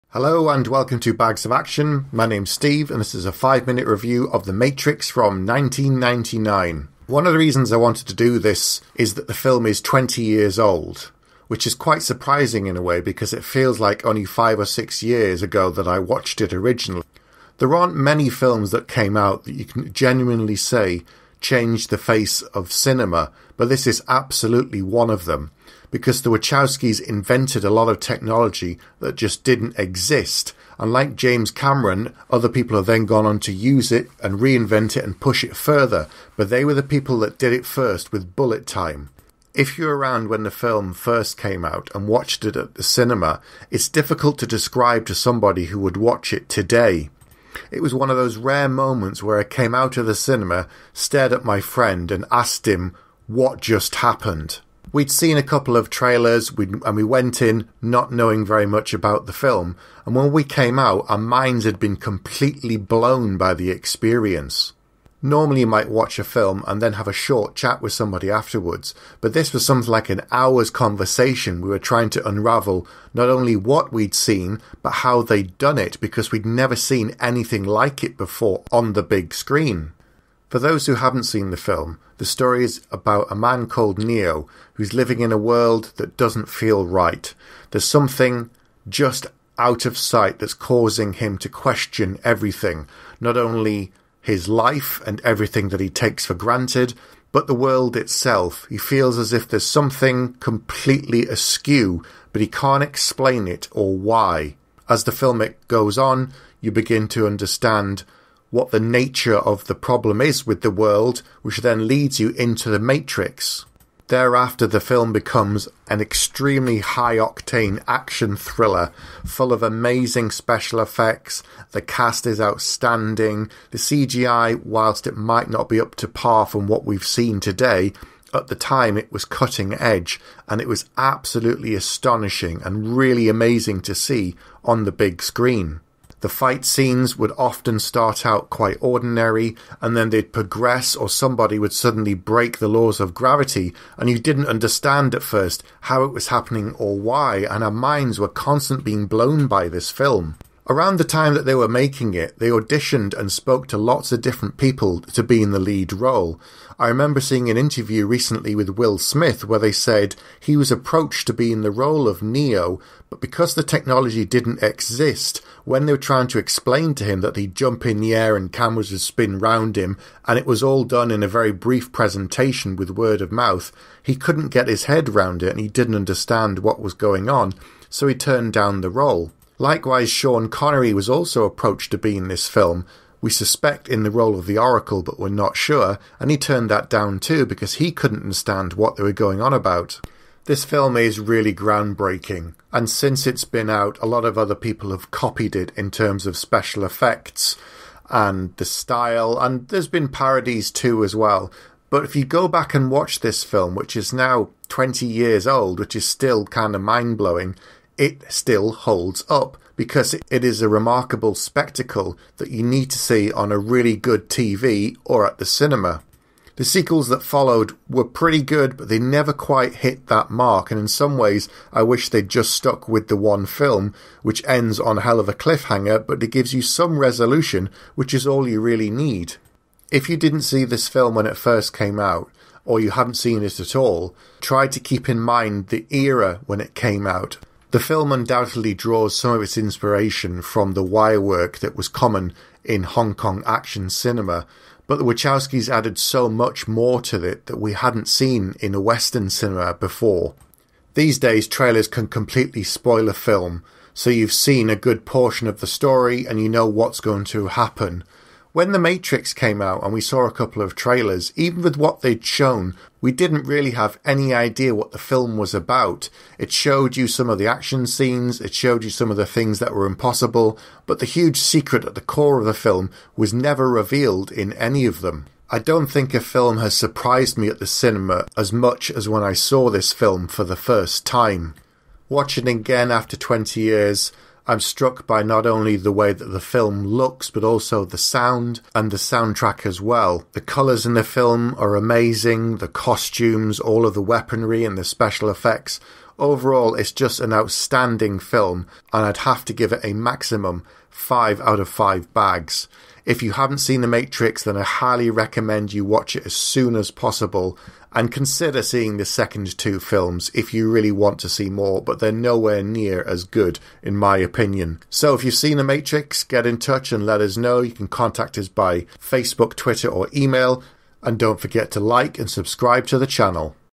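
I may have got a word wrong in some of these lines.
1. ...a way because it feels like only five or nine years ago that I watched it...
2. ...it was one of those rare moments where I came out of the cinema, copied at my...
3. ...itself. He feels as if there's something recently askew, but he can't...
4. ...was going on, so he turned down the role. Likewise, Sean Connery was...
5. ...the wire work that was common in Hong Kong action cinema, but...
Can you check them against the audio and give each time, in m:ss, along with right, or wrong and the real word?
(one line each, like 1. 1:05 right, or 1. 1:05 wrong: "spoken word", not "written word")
1. 0:12 wrong: "six", not "nine"
2. 0:47 wrong: "stared", not "copied"
3. 1:37 wrong: "completely", not "recently"
4. 2:56 right
5. 4:00 right.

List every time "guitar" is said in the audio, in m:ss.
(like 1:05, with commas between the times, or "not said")
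not said.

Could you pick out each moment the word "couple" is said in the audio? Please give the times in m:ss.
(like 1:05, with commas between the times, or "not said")
0:55, 4:20.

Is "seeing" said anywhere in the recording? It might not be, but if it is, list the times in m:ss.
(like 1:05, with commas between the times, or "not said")
2:37, 5:08.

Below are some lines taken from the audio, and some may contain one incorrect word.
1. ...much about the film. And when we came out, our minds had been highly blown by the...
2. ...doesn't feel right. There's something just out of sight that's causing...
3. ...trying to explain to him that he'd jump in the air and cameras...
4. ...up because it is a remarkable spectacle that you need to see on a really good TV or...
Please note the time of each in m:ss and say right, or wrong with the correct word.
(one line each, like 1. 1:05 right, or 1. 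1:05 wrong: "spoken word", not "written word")
1. 0:58 wrong: "completely", not "highly"
2. 1:26 right
3. 2:45 right
4. 3:29 right.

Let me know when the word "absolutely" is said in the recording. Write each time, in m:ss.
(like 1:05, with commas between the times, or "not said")
0:24, 2:10.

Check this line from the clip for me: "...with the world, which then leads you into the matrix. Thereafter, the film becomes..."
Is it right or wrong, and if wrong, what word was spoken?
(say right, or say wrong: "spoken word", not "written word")
right.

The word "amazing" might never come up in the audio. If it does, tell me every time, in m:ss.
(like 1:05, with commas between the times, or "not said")
1:59, 2:13, 4:51.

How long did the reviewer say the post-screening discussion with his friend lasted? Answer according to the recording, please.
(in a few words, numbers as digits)
An hour.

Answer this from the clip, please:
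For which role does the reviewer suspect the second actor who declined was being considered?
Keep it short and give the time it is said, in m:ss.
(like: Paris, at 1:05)
The Oracle, at 3:04.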